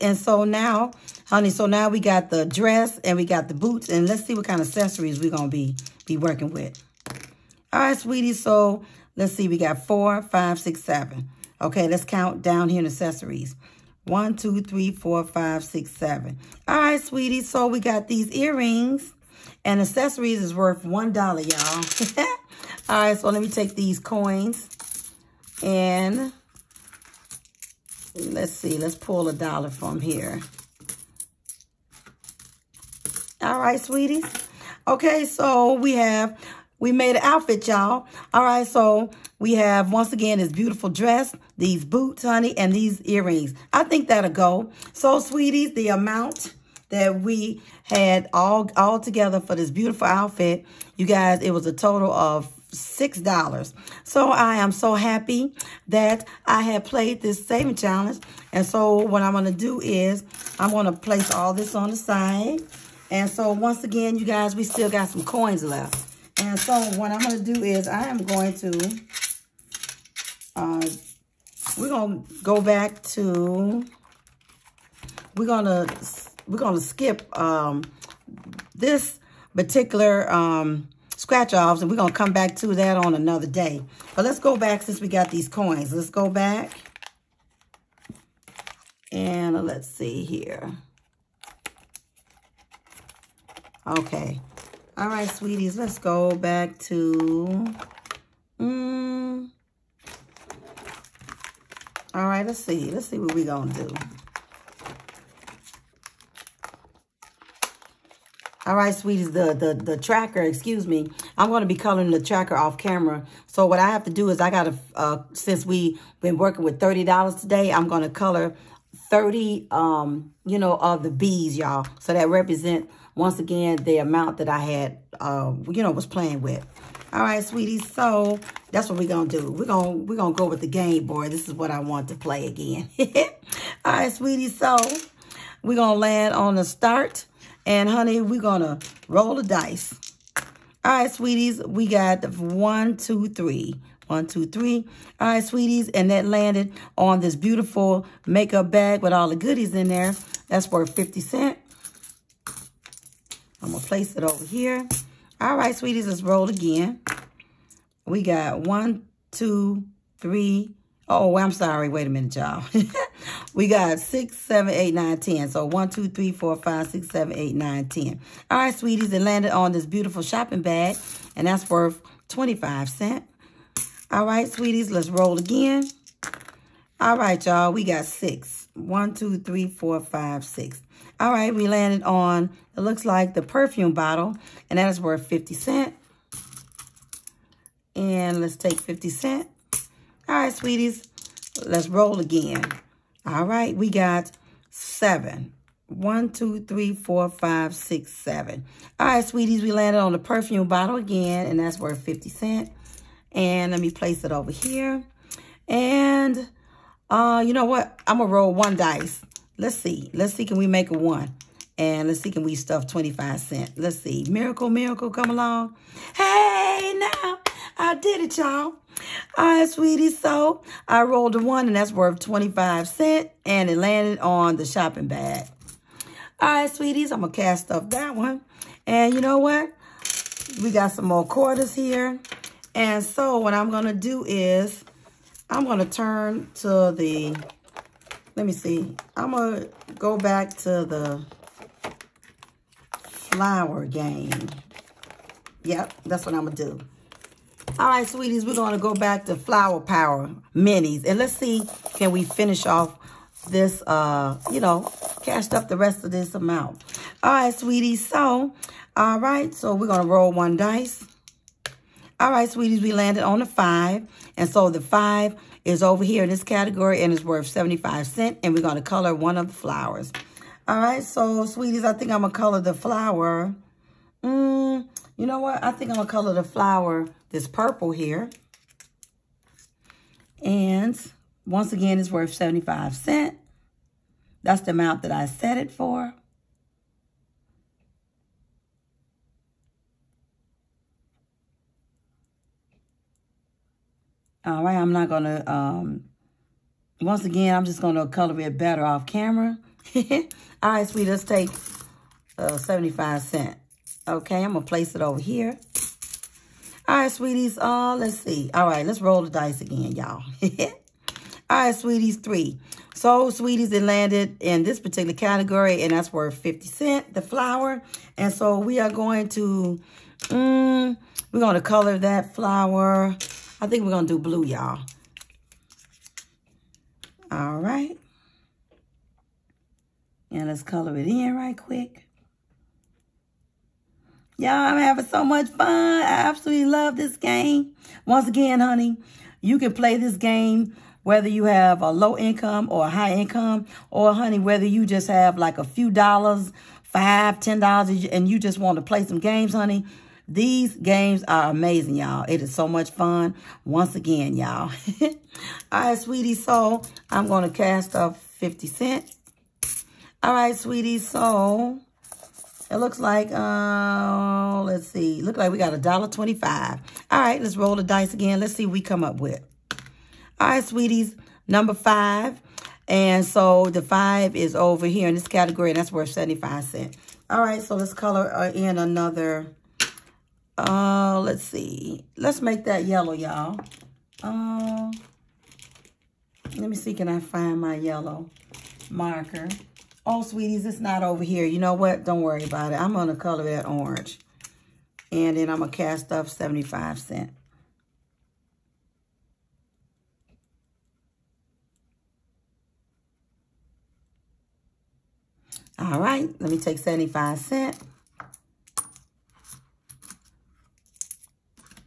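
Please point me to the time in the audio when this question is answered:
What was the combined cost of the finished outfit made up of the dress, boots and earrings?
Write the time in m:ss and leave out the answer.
0:52.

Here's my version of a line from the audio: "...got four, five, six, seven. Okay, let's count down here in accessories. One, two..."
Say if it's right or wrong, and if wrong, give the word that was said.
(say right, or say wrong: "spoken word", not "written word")
right.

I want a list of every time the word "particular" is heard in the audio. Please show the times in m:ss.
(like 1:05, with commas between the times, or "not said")
1:19, 5:14.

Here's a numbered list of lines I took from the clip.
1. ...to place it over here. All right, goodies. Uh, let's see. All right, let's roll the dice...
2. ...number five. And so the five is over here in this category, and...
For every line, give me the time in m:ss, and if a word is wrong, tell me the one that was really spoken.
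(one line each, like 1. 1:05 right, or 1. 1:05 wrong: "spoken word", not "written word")
1. 5:04 wrong: "sweeties", not "goodies"
2. 6:11 right.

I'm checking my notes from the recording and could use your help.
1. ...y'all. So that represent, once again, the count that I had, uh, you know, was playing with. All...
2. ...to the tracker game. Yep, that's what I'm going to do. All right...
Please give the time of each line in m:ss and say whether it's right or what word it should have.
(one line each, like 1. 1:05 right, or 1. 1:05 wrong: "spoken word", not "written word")
1. 2:01 wrong: "amount", not "count"
2. 4:00 wrong: "flower", not "tracker".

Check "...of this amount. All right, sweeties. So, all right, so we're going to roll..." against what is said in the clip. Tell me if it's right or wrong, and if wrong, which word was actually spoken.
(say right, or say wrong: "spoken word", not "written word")
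right.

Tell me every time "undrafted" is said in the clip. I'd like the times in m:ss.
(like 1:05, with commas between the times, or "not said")
not said.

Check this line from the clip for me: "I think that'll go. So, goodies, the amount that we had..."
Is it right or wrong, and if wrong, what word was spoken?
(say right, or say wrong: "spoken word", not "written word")
wrong: "sweeties", not "goodies".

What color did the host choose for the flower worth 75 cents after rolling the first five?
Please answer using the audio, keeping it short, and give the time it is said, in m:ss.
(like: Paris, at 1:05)
purple, at 4:37.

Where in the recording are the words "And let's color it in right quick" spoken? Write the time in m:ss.
5:30.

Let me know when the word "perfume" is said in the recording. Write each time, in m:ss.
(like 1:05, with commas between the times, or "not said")
3:03, 3:20.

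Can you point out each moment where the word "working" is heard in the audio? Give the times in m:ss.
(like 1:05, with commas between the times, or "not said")
0:06, 1:56.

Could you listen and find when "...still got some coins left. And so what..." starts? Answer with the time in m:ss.
1:04.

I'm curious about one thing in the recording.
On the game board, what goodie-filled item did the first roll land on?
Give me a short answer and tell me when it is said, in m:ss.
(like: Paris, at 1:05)
makeup bag, at 2:28.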